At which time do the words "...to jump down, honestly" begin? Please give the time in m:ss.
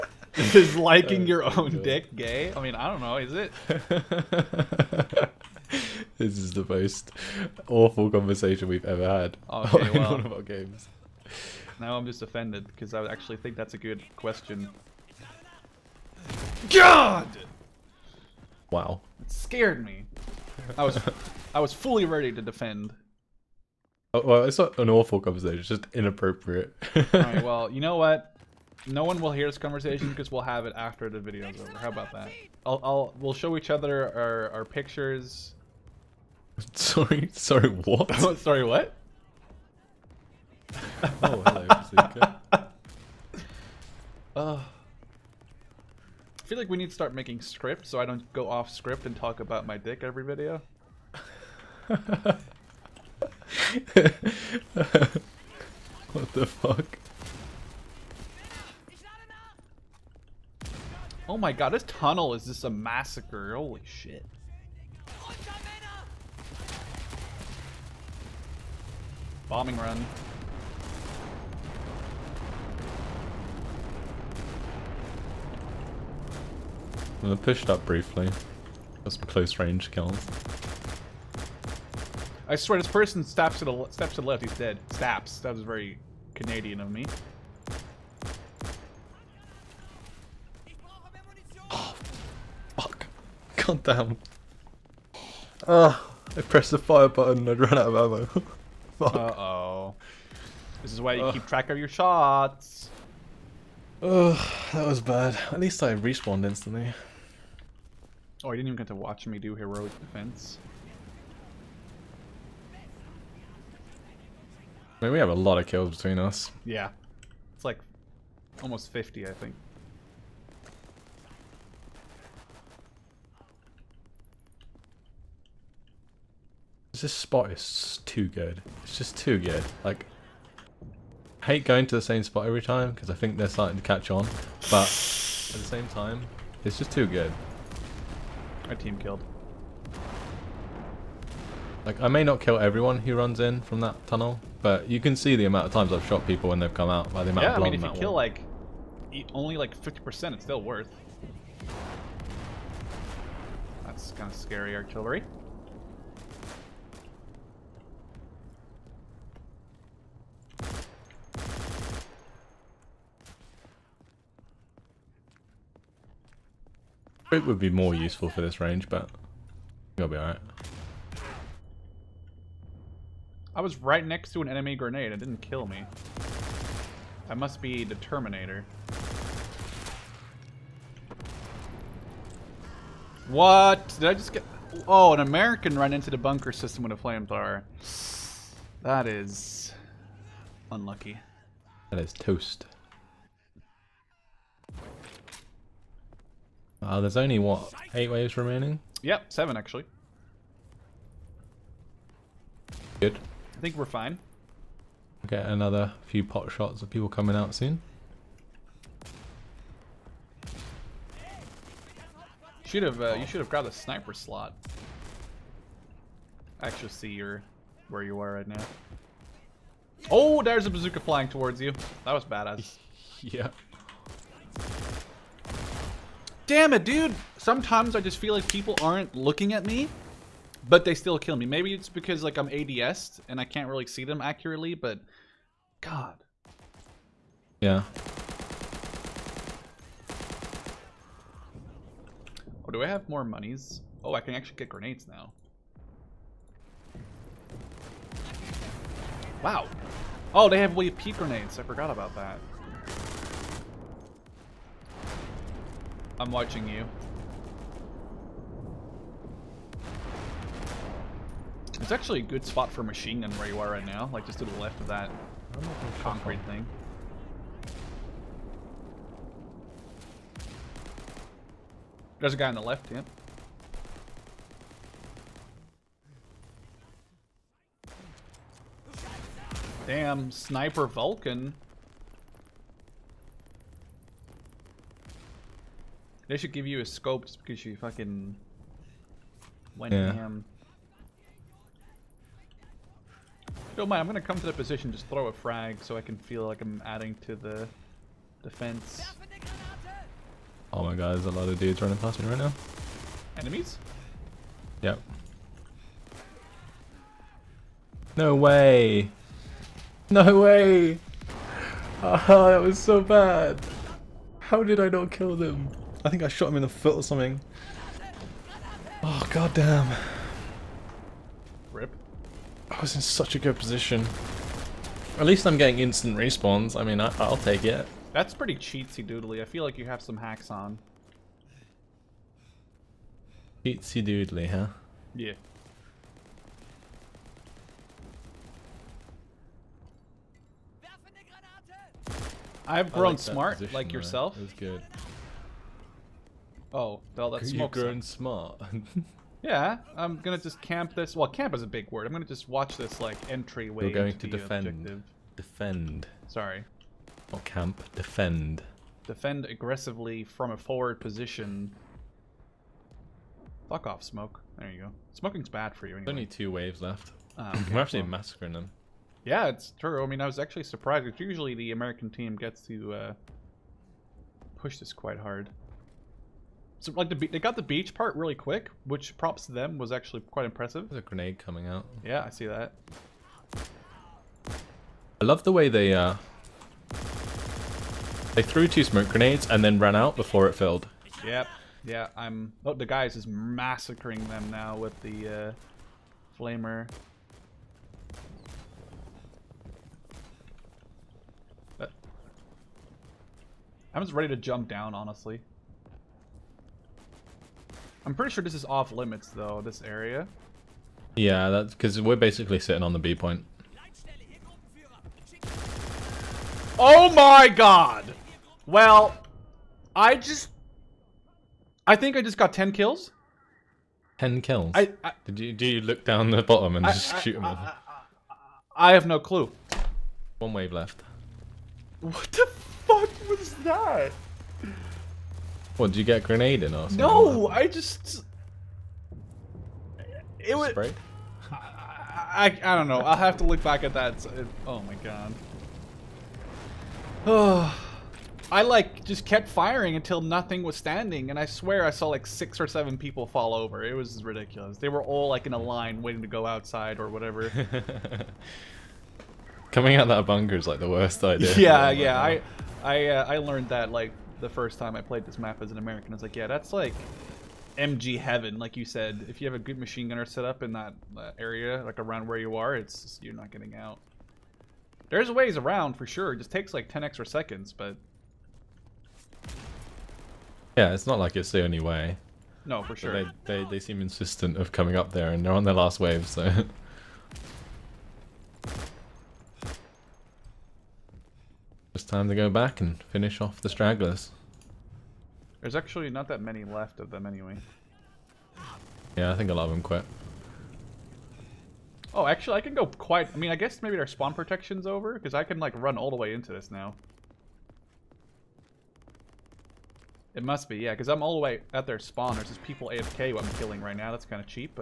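6:44.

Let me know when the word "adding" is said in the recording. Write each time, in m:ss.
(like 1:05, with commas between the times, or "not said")
4:56.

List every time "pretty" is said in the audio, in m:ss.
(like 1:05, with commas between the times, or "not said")
5:28, 6:48.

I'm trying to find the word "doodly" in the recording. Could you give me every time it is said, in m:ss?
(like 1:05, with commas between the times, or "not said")
5:29, 5:34.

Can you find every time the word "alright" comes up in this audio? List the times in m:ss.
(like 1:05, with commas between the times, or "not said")
0:27, 2:50.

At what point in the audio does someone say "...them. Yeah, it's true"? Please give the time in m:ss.
6:08.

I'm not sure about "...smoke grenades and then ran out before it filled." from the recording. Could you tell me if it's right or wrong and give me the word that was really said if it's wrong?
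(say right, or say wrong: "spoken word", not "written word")
right.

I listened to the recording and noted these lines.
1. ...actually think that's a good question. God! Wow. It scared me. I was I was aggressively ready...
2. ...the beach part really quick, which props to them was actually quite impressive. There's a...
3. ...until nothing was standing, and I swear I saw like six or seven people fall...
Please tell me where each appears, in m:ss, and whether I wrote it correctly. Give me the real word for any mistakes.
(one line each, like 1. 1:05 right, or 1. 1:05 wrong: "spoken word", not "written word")
1. 0:13 wrong: "fully", not "aggressively"
2. 6:17 right
3. 7:29 right.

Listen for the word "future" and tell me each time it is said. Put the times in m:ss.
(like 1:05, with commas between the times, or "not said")
not said.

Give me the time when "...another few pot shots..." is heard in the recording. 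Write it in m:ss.
3:25.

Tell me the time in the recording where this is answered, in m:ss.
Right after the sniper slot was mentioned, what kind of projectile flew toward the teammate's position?
3:40.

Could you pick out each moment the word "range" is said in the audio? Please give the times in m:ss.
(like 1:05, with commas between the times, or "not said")
1:19, 2:48.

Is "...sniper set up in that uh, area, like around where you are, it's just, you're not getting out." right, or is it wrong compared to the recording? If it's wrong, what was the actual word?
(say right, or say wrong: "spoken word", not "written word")
wrong: "gunner", not "sniper".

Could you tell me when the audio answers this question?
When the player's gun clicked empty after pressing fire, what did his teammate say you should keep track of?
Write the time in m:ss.
1:41.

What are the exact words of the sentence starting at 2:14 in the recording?
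But at the same time, it's just too good my team killed.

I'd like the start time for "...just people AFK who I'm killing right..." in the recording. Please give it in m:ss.
8:32.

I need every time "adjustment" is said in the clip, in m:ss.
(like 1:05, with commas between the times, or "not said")
not said.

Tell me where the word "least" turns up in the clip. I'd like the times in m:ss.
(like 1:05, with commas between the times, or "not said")
1:45, 5:25.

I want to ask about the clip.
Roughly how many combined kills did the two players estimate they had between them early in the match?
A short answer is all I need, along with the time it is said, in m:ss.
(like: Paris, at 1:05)
50, at 1:58.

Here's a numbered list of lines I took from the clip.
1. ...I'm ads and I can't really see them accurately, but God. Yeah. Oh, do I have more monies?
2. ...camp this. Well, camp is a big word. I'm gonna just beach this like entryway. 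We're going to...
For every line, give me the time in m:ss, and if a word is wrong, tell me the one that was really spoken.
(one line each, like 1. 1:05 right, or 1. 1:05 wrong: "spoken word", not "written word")
1. 3:52 right
2. 5:50 wrong: "watch", not "beach".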